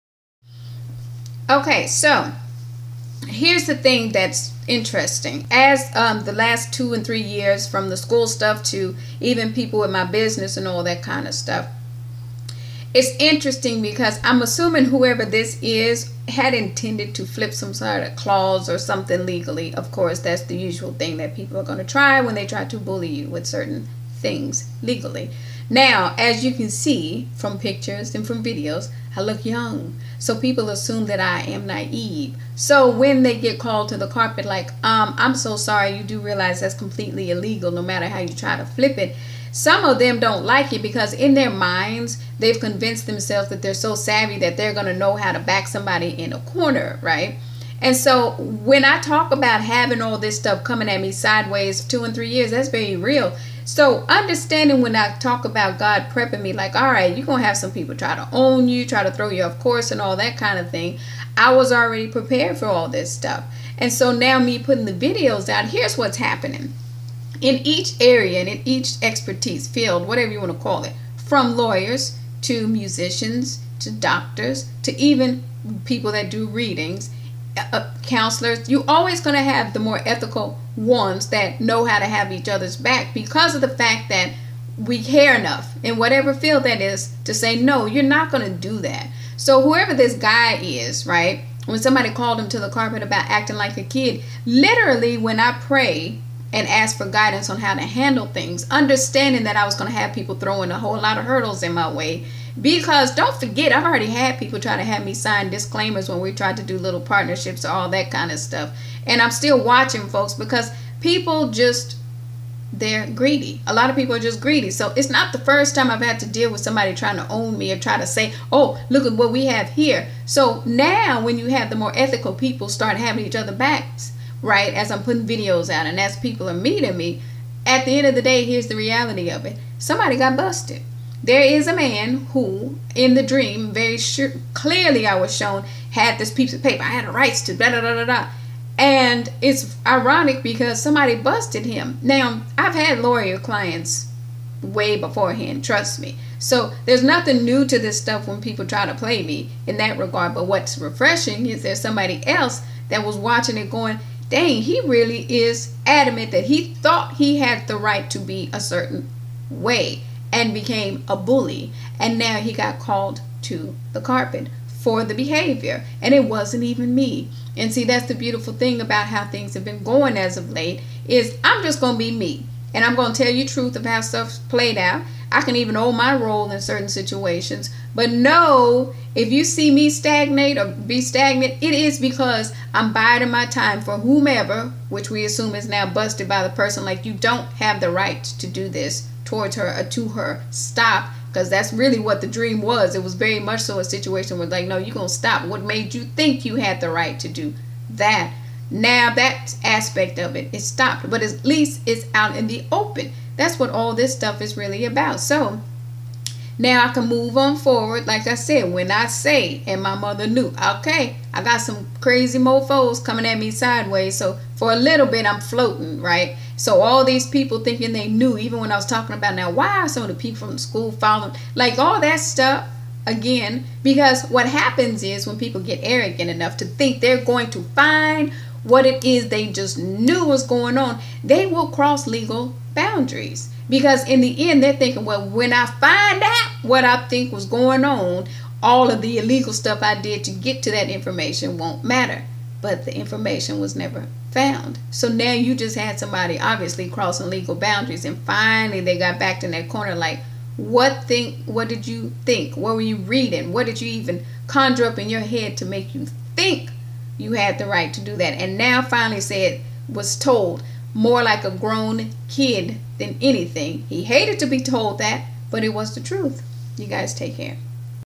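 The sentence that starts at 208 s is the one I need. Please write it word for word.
Like I said, when I say, and my mother knew, okay, I got some crazy mofos coming at me sideways.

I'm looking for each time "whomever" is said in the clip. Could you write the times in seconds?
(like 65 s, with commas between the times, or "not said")
183 s.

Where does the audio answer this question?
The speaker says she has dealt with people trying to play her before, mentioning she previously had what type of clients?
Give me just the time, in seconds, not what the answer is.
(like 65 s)
142 s.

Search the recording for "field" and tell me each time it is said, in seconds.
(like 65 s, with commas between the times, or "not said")
69 s, 86 s.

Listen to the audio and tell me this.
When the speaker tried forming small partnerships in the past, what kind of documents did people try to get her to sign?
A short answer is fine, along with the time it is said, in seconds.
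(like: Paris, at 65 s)
disclaimers, at 105 s.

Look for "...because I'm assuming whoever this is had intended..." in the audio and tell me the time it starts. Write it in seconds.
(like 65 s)
13 s.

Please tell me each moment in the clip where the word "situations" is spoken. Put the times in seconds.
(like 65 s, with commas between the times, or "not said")
176 s, 193 s.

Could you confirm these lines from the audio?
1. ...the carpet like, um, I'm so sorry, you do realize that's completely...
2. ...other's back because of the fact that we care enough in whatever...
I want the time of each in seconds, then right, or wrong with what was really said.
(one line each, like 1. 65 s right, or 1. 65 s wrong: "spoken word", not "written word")
1. 33 s right
2. 82 s right.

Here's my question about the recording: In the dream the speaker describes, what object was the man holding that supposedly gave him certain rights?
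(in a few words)
piece of paper.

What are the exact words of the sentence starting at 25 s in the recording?
Now, as you can see from pictures and from videos, I look young.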